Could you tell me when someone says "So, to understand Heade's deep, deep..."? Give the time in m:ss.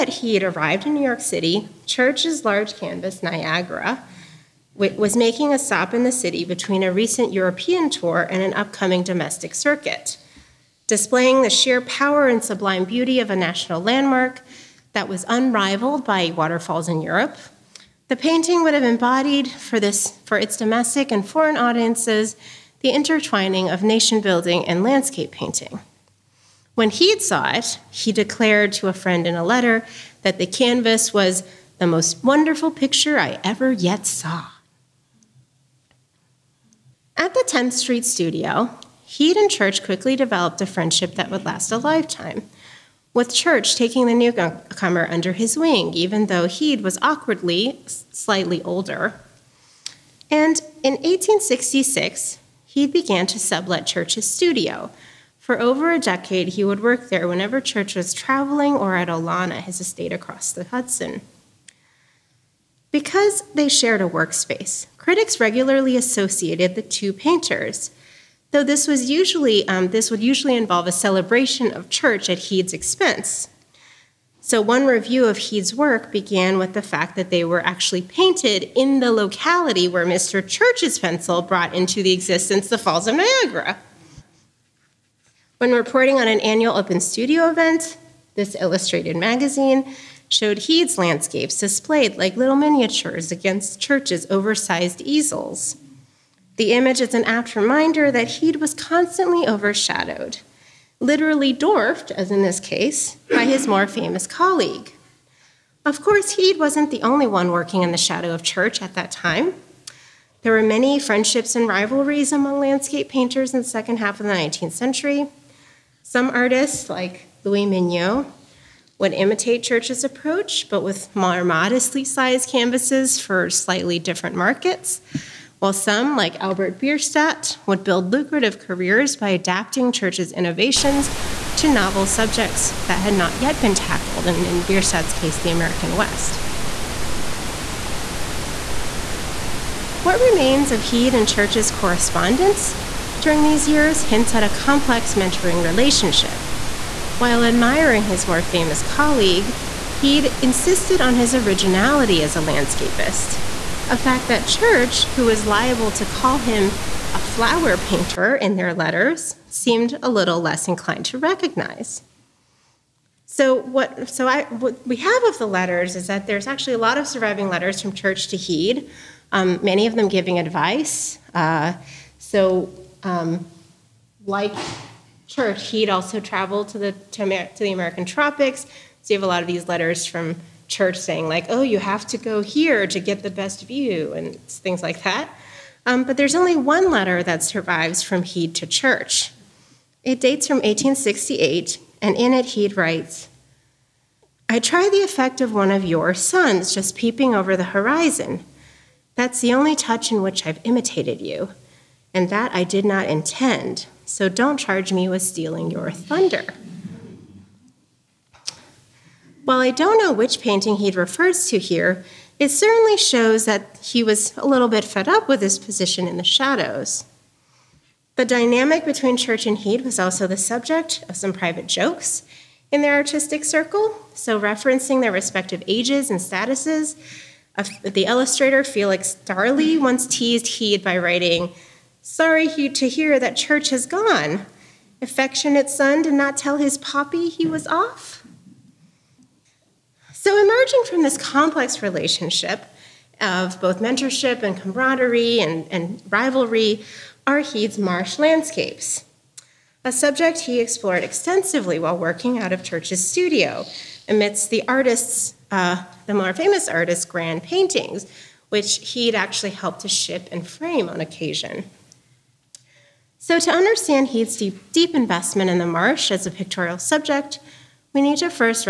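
4:23.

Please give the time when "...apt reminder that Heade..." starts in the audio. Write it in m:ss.
1:37.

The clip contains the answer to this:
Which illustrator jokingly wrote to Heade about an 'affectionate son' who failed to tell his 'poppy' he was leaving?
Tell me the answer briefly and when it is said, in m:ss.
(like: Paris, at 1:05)
Felix Darley, at 3:48.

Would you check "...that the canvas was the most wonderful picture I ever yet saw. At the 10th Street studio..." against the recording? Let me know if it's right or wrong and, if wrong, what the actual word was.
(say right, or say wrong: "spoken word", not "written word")
right.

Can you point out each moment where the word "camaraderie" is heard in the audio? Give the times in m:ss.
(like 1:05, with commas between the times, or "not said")
4:04.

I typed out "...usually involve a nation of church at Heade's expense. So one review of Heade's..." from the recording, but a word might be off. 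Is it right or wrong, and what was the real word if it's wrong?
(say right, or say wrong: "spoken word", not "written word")
wrong: "celebration", not "nation".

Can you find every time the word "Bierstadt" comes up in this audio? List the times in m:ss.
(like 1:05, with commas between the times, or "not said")
2:06, 2:14.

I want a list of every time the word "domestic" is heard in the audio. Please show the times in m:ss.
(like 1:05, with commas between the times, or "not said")
0:09, 0:20.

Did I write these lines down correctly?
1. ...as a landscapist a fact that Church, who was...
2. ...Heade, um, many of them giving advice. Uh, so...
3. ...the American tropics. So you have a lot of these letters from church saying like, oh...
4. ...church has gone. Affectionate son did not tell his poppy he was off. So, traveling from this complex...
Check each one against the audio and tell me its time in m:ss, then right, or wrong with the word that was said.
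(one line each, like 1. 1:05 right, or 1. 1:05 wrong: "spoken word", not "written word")
1. 2:32 right
2. 2:48 right
3. 2:57 right
4. 3:53 wrong: "emerging", not "traveling".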